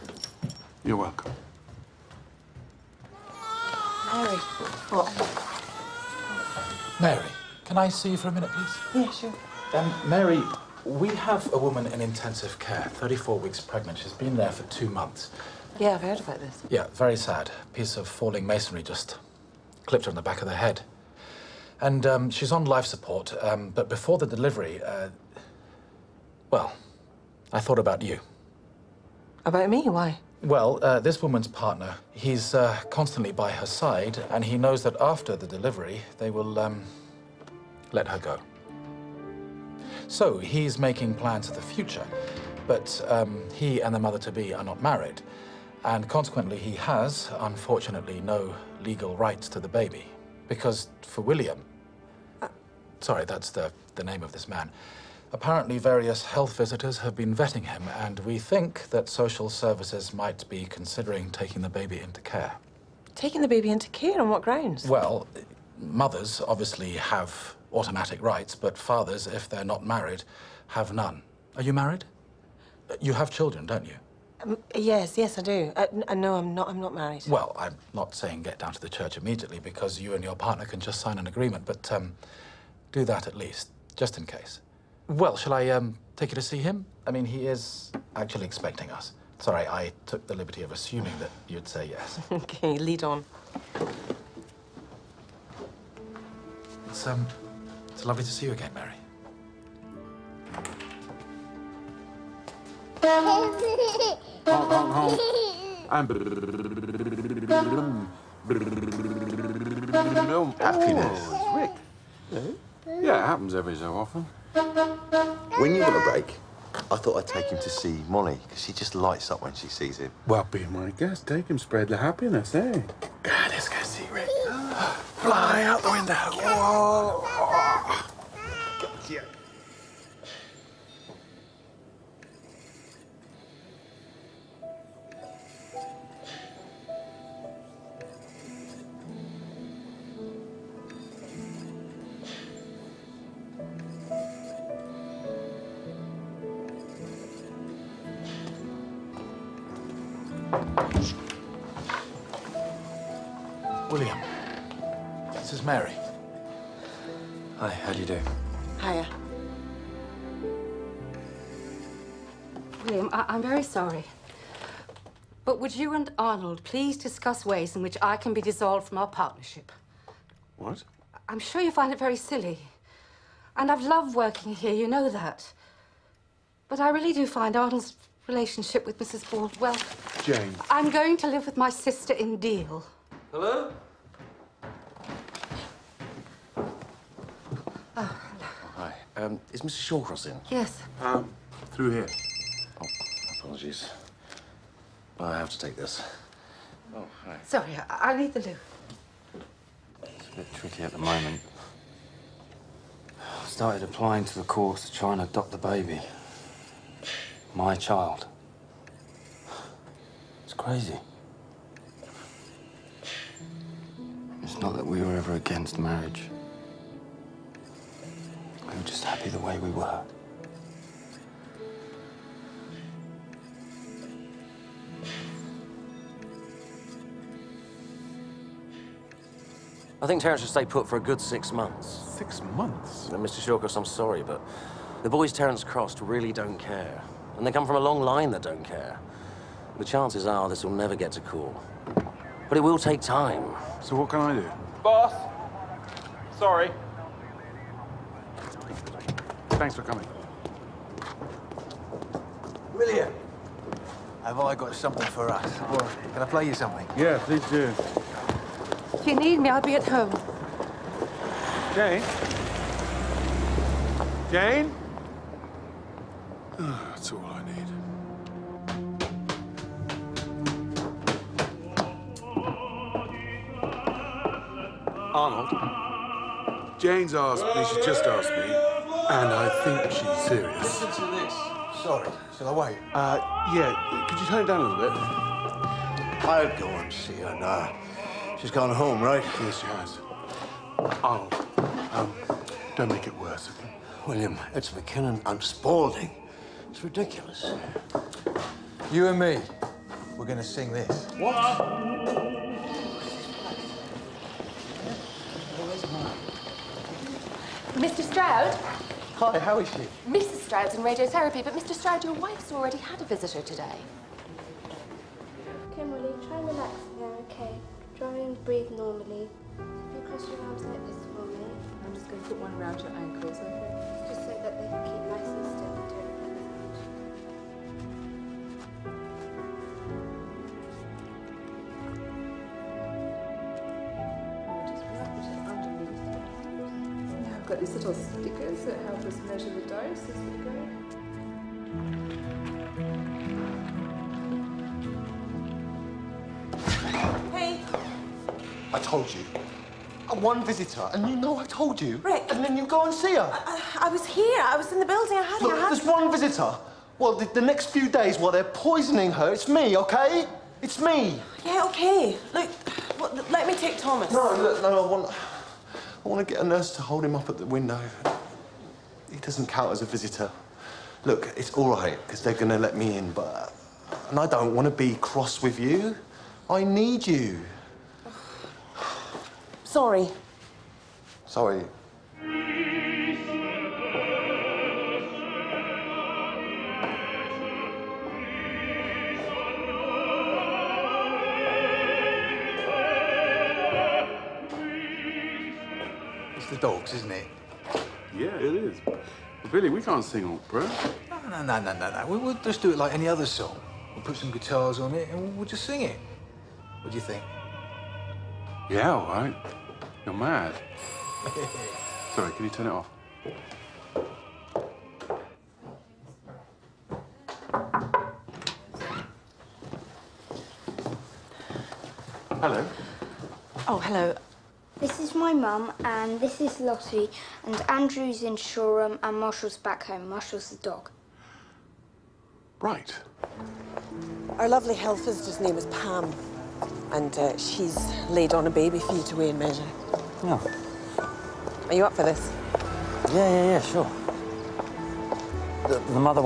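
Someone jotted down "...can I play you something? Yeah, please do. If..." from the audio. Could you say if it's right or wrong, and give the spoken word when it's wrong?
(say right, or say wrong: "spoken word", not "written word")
right.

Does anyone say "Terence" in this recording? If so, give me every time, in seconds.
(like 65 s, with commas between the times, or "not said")
230 s, 235 s.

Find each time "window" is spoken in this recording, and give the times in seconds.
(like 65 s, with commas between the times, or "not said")
125 s, 367 s.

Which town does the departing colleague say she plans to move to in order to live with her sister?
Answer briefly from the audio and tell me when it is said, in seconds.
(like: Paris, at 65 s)
Deal, at 182 s.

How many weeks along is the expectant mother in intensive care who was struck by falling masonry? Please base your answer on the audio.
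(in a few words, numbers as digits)
34.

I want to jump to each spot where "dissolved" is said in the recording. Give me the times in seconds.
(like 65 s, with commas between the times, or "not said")
168 s.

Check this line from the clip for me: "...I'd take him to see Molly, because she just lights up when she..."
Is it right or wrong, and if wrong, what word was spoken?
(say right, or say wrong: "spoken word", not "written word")
right.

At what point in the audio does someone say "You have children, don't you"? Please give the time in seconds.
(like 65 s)
72 s.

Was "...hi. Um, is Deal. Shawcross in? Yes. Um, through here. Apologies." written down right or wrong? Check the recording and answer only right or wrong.
wrong.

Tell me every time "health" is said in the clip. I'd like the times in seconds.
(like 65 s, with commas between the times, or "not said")
56 s, 434 s.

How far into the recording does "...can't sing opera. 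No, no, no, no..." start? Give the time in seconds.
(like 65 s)
399 s.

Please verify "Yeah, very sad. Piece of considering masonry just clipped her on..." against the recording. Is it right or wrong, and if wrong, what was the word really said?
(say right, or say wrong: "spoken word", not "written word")
wrong: "falling", not "considering".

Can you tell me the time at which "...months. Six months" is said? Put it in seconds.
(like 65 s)
231 s.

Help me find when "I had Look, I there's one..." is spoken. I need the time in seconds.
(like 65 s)
355 s.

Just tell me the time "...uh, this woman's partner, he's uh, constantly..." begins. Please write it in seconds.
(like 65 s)
30 s.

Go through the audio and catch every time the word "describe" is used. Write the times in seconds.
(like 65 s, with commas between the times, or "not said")
not said.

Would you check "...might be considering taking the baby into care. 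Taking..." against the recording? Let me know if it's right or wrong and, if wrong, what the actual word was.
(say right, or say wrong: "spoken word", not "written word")
right.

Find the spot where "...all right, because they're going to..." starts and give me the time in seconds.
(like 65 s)
371 s.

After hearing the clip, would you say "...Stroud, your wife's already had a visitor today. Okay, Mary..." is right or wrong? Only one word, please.
wrong.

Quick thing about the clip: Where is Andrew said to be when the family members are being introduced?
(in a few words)
Shoreham.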